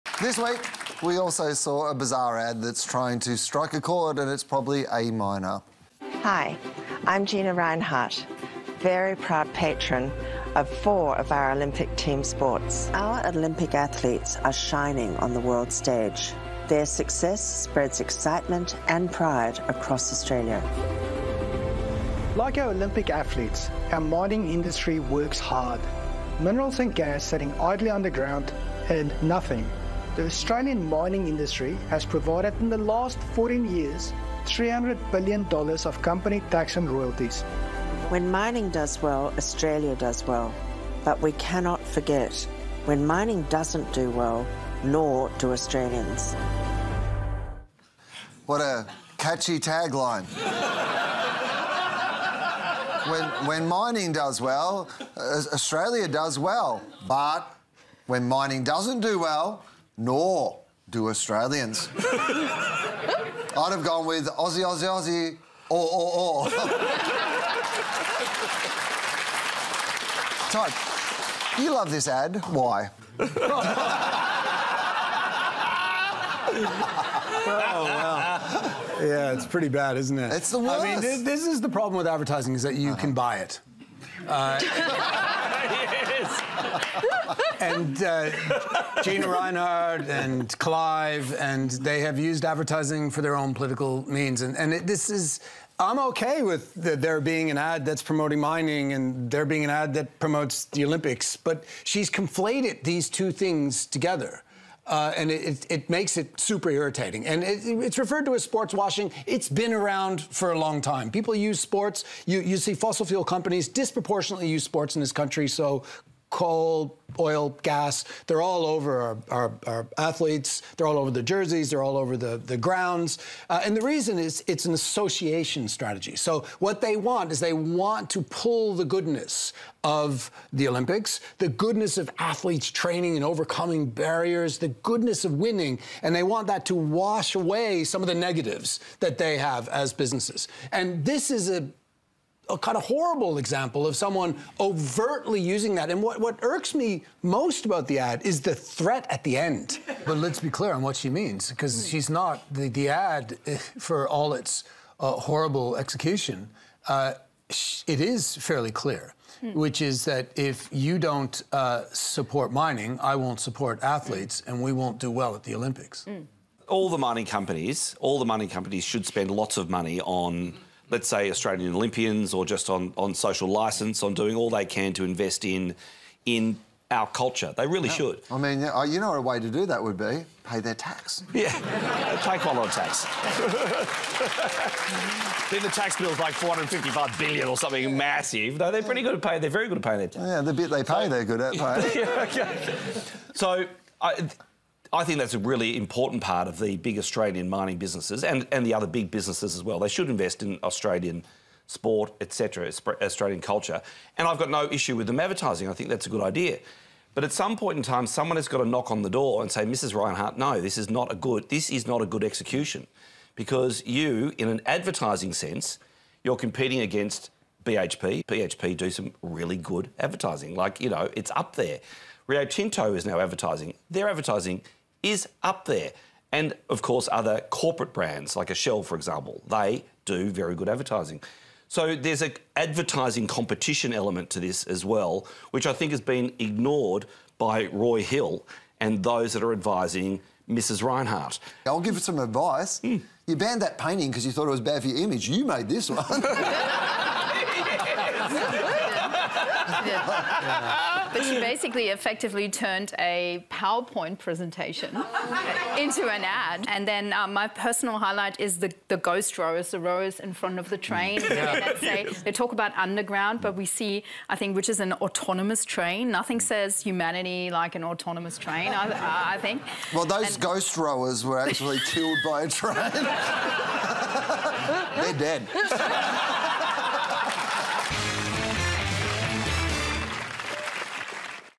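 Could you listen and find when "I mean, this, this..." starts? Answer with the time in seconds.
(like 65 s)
80 s.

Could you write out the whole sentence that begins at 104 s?
Uh, and it, it, it, makes it super irritating.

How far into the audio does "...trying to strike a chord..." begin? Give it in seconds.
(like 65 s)
2 s.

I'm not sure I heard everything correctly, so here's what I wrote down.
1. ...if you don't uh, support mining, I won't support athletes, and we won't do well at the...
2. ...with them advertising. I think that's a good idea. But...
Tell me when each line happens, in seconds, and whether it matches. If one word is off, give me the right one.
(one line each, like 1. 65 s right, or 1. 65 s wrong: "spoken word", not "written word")
1. 160 s right
2. 204 s right.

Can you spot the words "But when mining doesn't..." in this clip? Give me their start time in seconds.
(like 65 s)
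57 s.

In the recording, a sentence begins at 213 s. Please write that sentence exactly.
Because you, in an advertising sense, you're competing against BHP.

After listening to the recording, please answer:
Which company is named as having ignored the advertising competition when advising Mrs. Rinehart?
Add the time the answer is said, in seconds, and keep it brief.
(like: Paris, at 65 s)
Roy Hill, at 237 s.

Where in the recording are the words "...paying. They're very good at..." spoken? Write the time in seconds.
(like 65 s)
189 s.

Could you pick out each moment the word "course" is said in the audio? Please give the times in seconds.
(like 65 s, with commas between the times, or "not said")
226 s.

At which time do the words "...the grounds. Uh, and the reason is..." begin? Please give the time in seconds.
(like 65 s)
122 s.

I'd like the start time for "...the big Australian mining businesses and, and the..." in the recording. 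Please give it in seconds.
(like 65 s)
196 s.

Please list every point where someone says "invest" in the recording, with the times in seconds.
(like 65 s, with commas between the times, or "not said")
175 s, 200 s.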